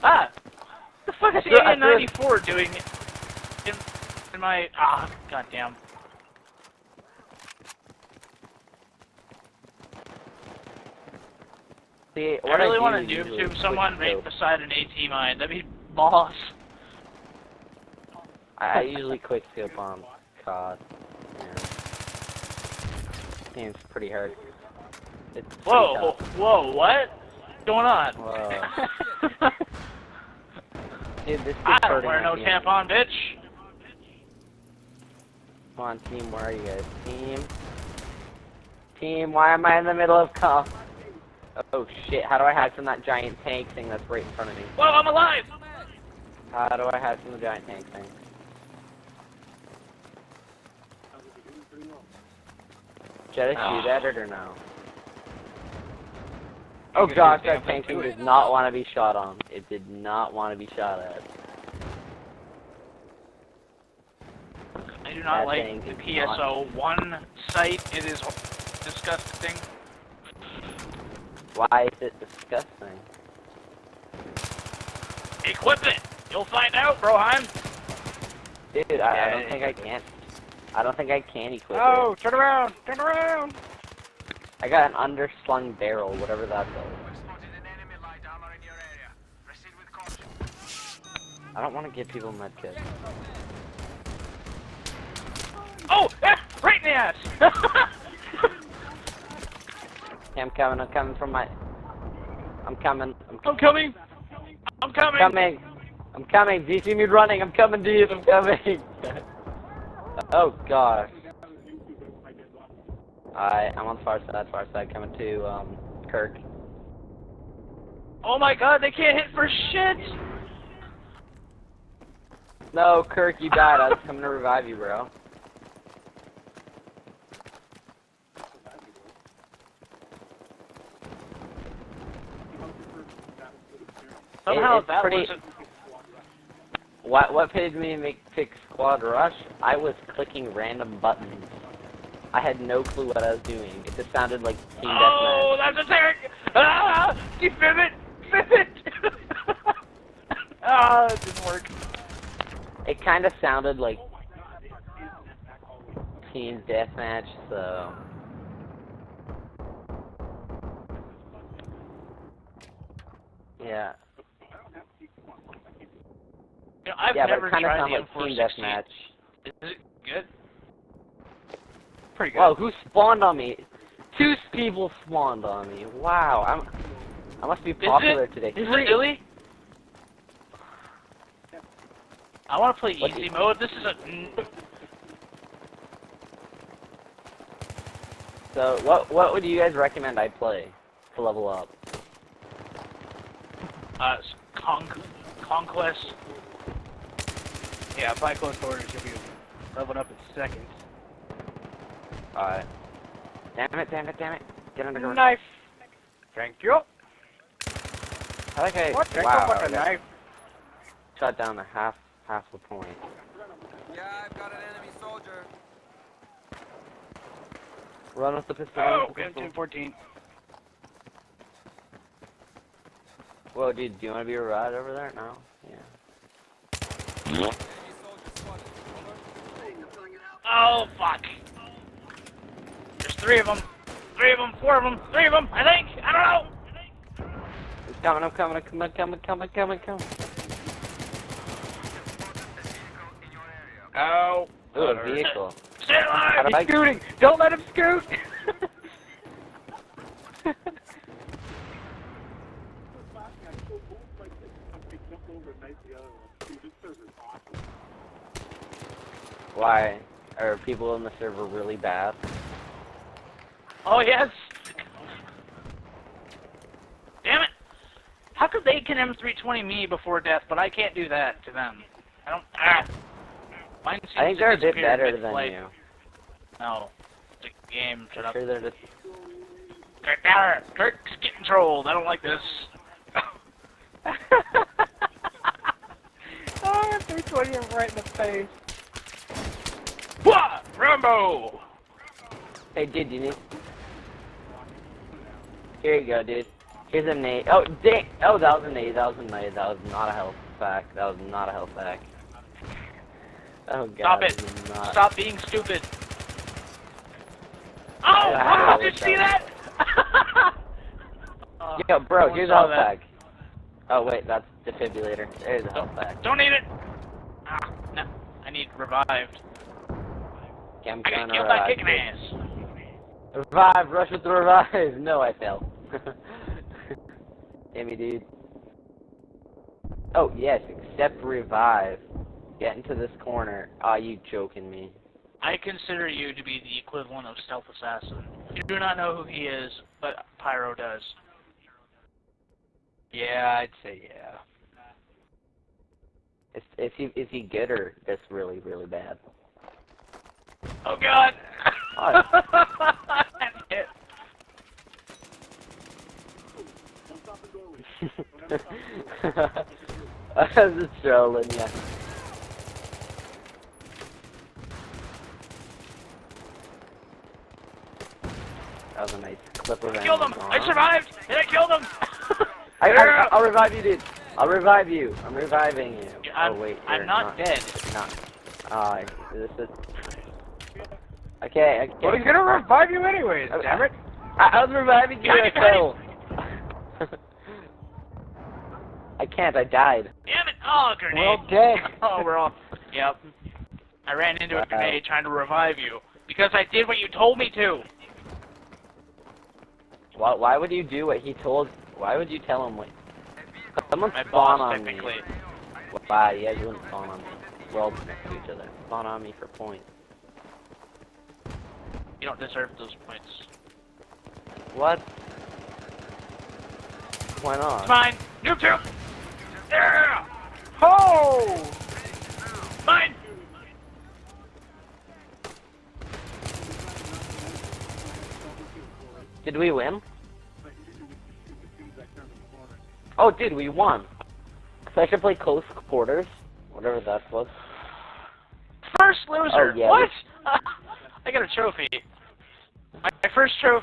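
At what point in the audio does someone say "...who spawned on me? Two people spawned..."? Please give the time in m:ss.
2:52.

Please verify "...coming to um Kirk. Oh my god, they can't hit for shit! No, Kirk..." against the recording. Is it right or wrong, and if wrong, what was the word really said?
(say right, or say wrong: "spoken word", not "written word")
right.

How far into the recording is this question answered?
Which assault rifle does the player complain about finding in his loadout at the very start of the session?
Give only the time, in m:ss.
0:01.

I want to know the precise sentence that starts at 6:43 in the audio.
Someone My spawn boss, on me.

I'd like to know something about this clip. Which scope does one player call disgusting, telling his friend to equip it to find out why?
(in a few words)
PSO one sight.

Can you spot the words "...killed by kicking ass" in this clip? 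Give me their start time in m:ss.
5:21.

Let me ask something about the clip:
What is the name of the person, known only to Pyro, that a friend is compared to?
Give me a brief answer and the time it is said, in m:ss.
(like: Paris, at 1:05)
Stealth Assassin, at 5:37.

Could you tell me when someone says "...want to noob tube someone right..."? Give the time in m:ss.
0:12.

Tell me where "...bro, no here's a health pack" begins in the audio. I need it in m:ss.
5:11.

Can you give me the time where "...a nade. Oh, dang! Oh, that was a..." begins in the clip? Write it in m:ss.
4:57.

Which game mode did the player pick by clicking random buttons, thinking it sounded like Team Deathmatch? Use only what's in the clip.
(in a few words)
Squad Rush.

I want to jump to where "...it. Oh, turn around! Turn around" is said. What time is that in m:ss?
1:21.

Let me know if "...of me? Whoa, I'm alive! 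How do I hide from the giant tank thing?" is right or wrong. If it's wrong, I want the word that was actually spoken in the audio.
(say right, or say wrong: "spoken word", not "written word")
right.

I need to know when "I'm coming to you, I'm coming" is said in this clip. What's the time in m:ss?
1:47.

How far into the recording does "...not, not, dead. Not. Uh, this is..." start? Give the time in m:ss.
6:17.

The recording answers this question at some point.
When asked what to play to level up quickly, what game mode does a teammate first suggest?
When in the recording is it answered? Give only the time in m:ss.
3:15.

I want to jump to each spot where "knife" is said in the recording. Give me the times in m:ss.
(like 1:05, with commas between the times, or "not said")
3:25, 3:29.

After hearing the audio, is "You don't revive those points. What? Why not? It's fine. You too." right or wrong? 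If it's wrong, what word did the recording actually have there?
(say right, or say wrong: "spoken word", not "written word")
wrong: "deserve", not "revive".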